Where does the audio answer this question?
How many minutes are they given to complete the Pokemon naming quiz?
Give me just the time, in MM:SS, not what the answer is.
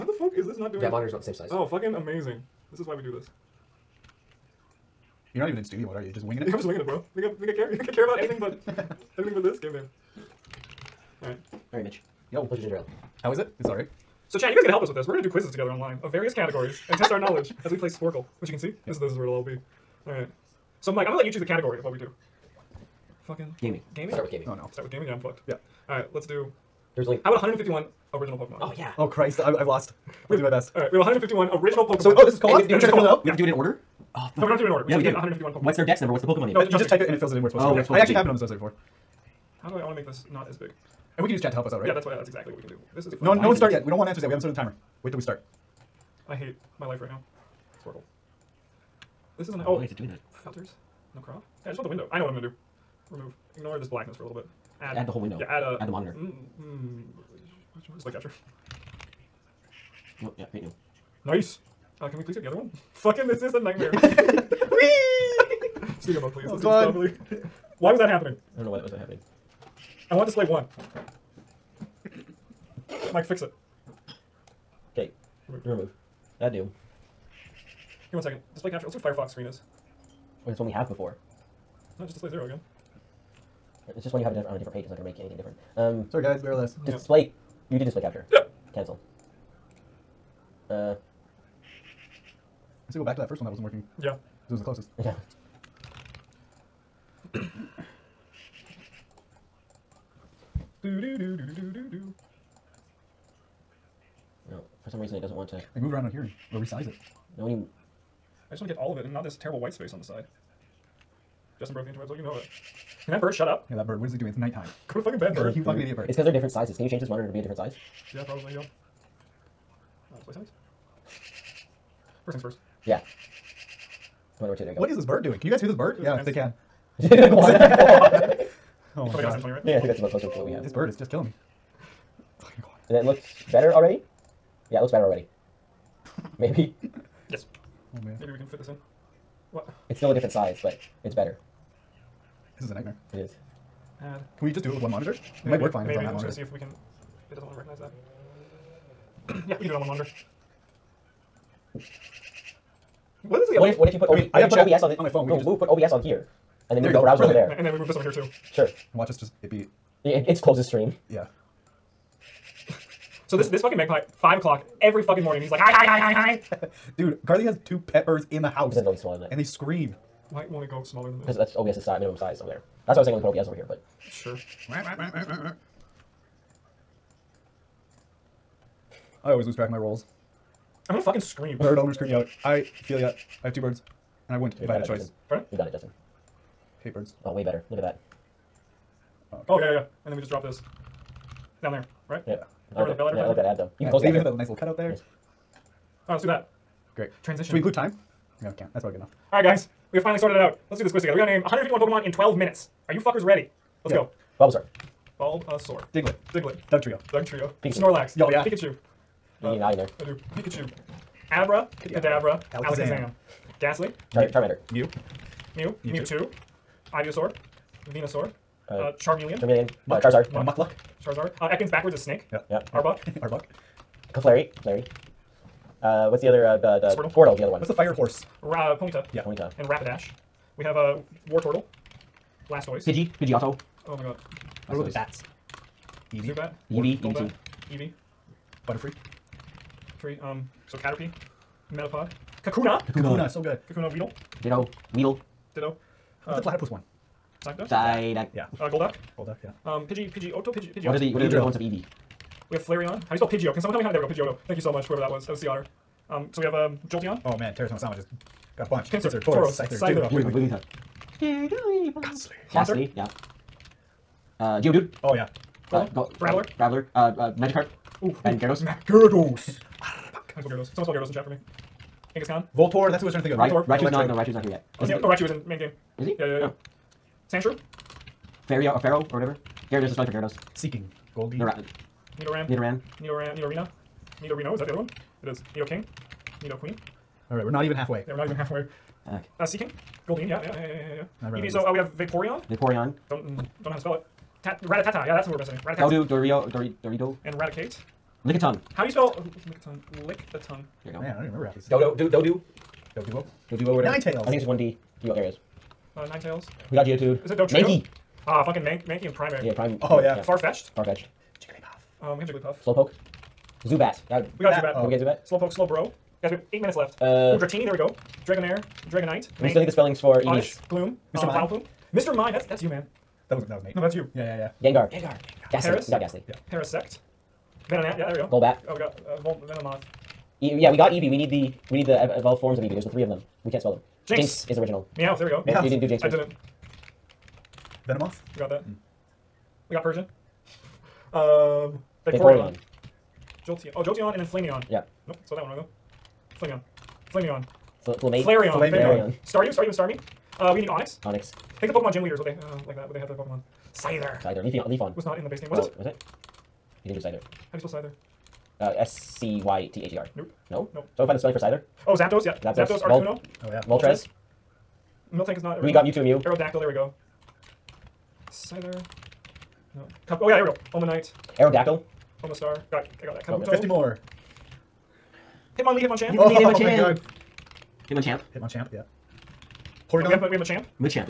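03:22.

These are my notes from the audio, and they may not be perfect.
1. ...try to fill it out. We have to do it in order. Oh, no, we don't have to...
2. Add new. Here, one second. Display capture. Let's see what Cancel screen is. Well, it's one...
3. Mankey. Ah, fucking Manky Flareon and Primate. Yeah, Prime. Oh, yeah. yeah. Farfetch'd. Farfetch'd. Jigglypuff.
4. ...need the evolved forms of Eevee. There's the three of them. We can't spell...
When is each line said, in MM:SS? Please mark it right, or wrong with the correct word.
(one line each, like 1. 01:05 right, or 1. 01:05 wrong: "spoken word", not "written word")
1. 00:32 right
2. 01:16 wrong: "Firefox", not "Cancel"
3. 05:07 wrong: "Mankey", not "Flareon"
4. 05:31 right.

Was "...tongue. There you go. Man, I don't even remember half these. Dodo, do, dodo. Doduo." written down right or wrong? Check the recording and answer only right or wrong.
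right.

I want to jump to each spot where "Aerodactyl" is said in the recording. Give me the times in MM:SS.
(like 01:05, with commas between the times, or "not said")
06:06, 06:11.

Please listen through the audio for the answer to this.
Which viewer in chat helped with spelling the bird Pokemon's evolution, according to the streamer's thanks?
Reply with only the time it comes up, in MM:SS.
04:15.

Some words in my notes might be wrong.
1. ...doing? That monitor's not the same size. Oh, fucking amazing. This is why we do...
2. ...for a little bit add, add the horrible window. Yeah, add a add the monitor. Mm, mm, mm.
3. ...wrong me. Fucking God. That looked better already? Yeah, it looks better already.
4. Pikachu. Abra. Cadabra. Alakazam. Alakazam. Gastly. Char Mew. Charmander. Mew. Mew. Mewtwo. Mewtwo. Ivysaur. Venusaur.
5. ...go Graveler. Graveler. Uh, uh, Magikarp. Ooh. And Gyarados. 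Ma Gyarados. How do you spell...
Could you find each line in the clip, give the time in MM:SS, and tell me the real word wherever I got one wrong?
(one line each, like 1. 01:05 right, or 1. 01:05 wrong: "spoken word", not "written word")
1. 00:00 right
2. 00:54 wrong: "whole", not "horrible"
3. 02:11 wrong: "killing", not "wrong"
4. 03:30 right
5. 04:25 right.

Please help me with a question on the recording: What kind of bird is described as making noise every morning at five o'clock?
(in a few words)
Magpie.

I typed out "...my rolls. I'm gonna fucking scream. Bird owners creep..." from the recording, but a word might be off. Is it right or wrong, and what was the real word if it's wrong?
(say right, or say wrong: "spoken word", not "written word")
right.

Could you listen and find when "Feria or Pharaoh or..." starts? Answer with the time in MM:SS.
04:38.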